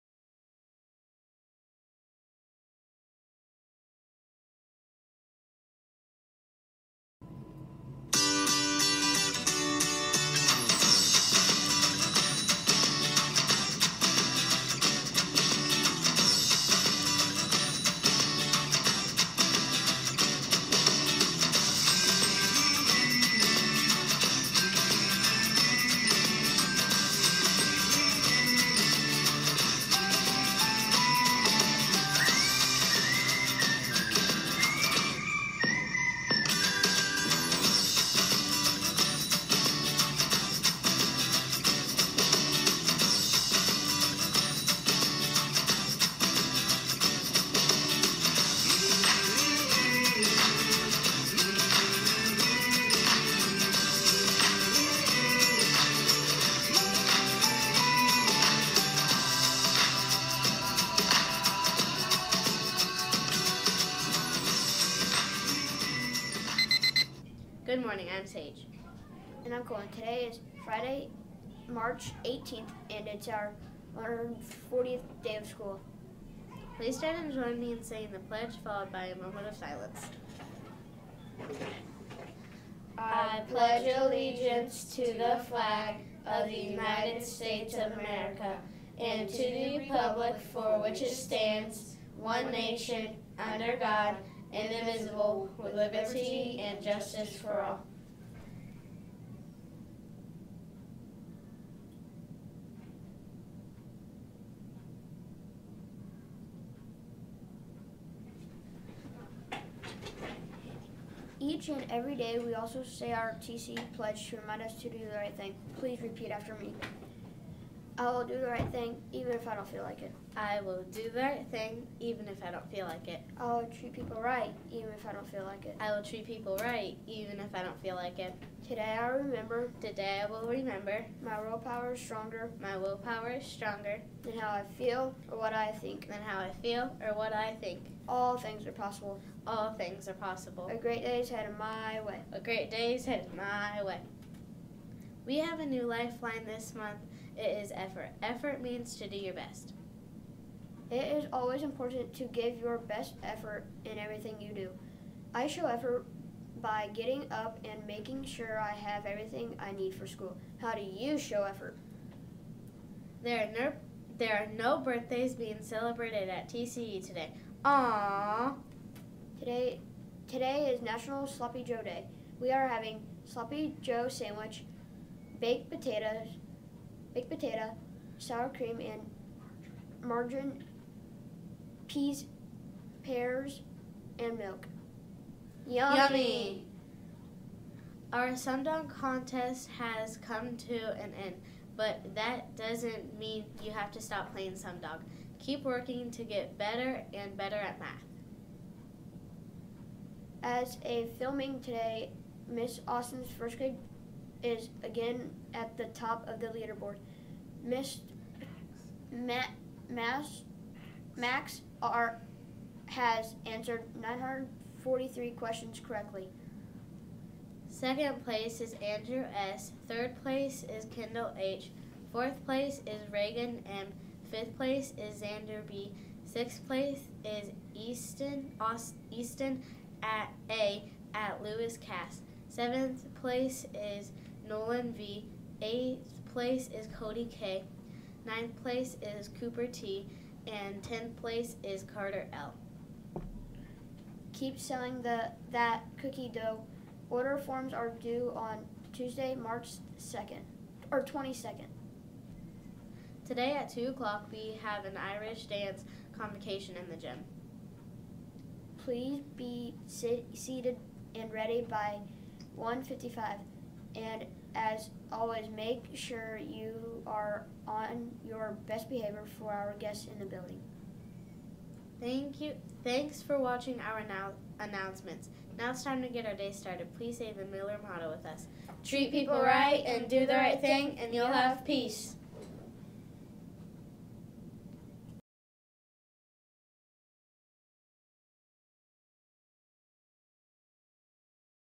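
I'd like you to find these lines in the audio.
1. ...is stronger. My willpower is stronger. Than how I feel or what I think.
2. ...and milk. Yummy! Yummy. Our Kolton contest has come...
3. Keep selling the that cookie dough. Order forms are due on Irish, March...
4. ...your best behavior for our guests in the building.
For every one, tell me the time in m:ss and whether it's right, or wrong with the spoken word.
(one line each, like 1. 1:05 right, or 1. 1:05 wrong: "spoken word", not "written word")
1. 2:11 right
2. 3:04 wrong: "Sumdog", not "Kolton"
3. 4:04 wrong: "Tuesday", not "Irish"
4. 4:28 right.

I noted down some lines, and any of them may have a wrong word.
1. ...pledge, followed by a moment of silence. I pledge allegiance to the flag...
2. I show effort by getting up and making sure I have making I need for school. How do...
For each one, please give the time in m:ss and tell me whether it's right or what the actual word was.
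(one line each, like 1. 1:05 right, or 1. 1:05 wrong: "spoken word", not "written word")
1. 1:18 right
2. 2:35 wrong: "everything", not "making".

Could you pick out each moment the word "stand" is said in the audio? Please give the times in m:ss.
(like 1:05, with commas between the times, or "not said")
1:16, 1:31.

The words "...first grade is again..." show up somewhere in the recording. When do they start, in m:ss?
3:23.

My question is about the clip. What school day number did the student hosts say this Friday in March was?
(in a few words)
140th.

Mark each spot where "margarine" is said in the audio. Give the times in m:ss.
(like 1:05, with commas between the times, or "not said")
3:00.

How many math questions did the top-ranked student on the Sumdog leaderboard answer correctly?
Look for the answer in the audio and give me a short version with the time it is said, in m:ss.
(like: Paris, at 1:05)
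943, at 3:34.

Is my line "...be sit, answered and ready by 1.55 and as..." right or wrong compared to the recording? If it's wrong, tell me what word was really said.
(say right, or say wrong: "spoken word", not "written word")
wrong: "seated", not "answered".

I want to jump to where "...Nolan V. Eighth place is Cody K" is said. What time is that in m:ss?
3:54.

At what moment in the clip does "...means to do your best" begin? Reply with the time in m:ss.
2:28.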